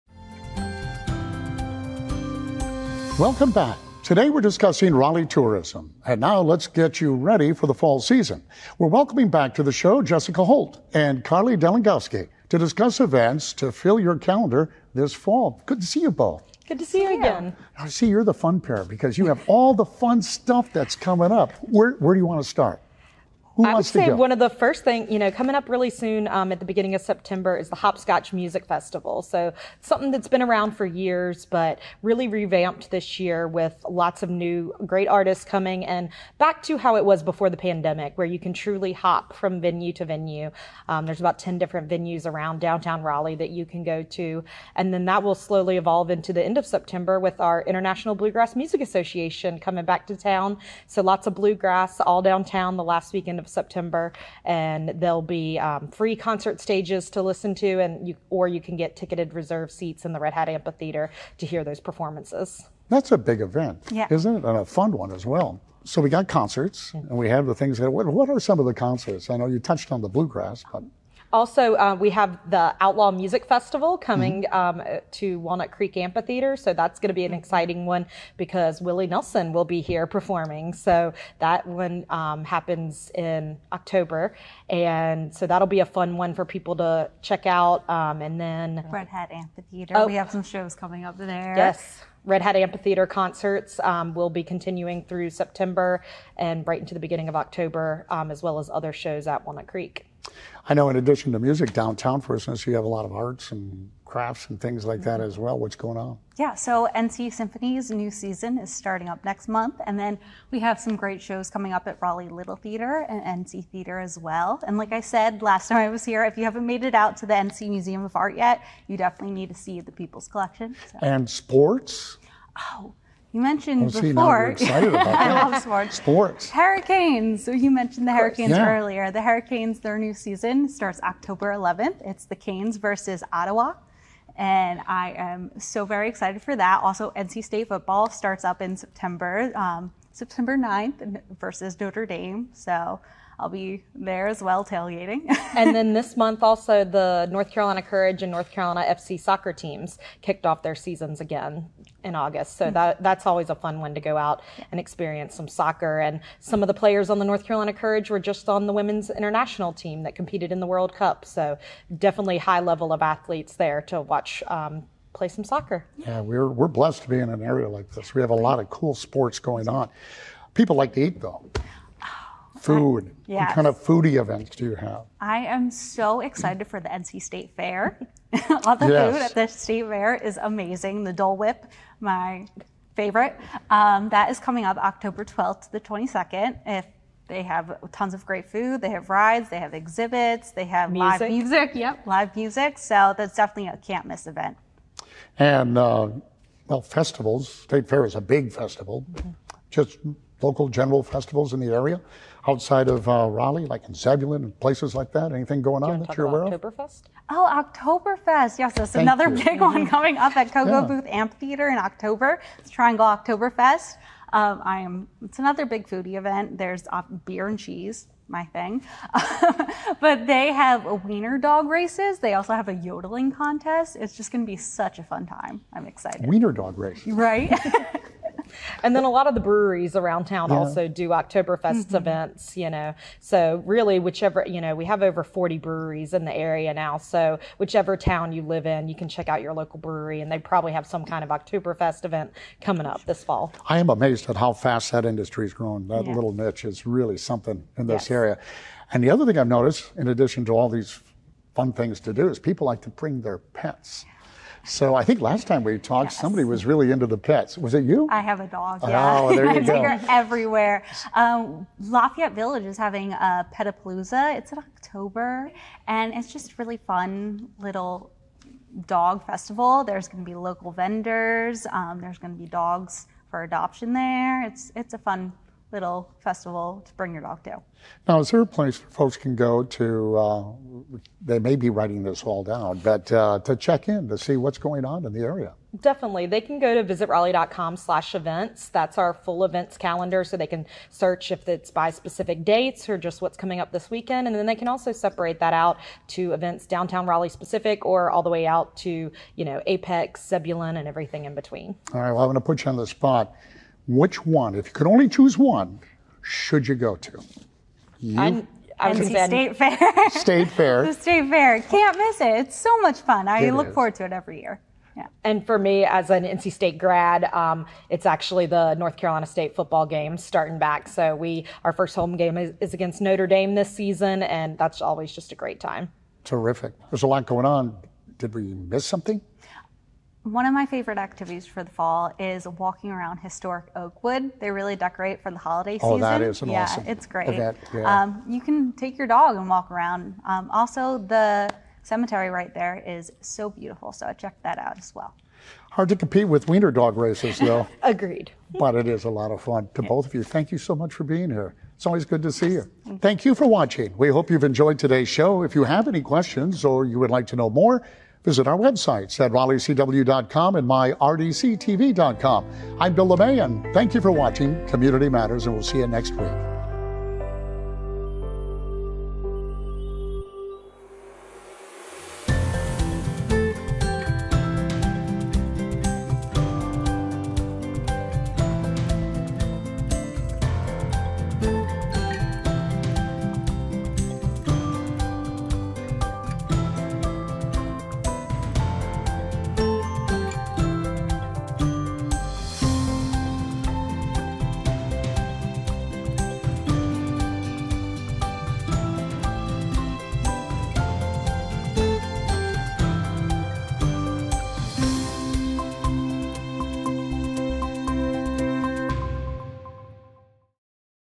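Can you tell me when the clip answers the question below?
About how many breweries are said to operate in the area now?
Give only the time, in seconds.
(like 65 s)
235 s.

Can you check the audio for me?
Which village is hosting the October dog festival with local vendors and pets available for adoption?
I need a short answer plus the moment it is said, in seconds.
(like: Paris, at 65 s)
Lafayette Village, at 261 s.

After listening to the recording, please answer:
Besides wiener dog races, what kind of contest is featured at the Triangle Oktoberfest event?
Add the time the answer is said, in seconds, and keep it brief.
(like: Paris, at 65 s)
yodeling contest, at 222 s.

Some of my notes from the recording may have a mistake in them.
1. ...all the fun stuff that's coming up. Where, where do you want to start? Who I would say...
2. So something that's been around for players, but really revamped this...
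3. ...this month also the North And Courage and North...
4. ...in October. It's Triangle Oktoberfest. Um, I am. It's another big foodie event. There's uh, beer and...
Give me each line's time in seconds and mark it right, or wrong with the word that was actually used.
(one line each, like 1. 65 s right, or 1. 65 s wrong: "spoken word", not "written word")
1. 19 s right
2. 29 s wrong: "years", not "players"
3. 145 s wrong: "Carolina", not "And"
4. 211 s right.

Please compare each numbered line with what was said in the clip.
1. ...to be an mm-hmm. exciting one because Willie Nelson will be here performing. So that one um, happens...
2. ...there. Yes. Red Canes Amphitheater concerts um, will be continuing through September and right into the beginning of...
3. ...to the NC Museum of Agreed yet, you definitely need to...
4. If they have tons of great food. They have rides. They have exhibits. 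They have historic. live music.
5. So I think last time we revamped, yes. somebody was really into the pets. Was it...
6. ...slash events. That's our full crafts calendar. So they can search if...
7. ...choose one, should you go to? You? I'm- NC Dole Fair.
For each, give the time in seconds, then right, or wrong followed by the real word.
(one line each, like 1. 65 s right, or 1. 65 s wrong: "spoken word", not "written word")
1. 77 s right
2. 91 s wrong: "Hat", not "Canes"
3. 117 s wrong: "Art", not "Agreed"
4. 186 s wrong: "music", not "historic"
5. 254 s wrong: "talked", not "revamped"
6. 287 s wrong: "events", not "crafts"
7. 305 s wrong: "State", not "Dole".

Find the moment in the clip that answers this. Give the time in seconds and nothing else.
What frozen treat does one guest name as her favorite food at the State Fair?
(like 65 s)
181 s.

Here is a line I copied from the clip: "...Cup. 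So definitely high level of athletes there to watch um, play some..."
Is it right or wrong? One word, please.
right.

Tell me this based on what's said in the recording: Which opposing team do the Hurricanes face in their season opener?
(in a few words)
Ottawa.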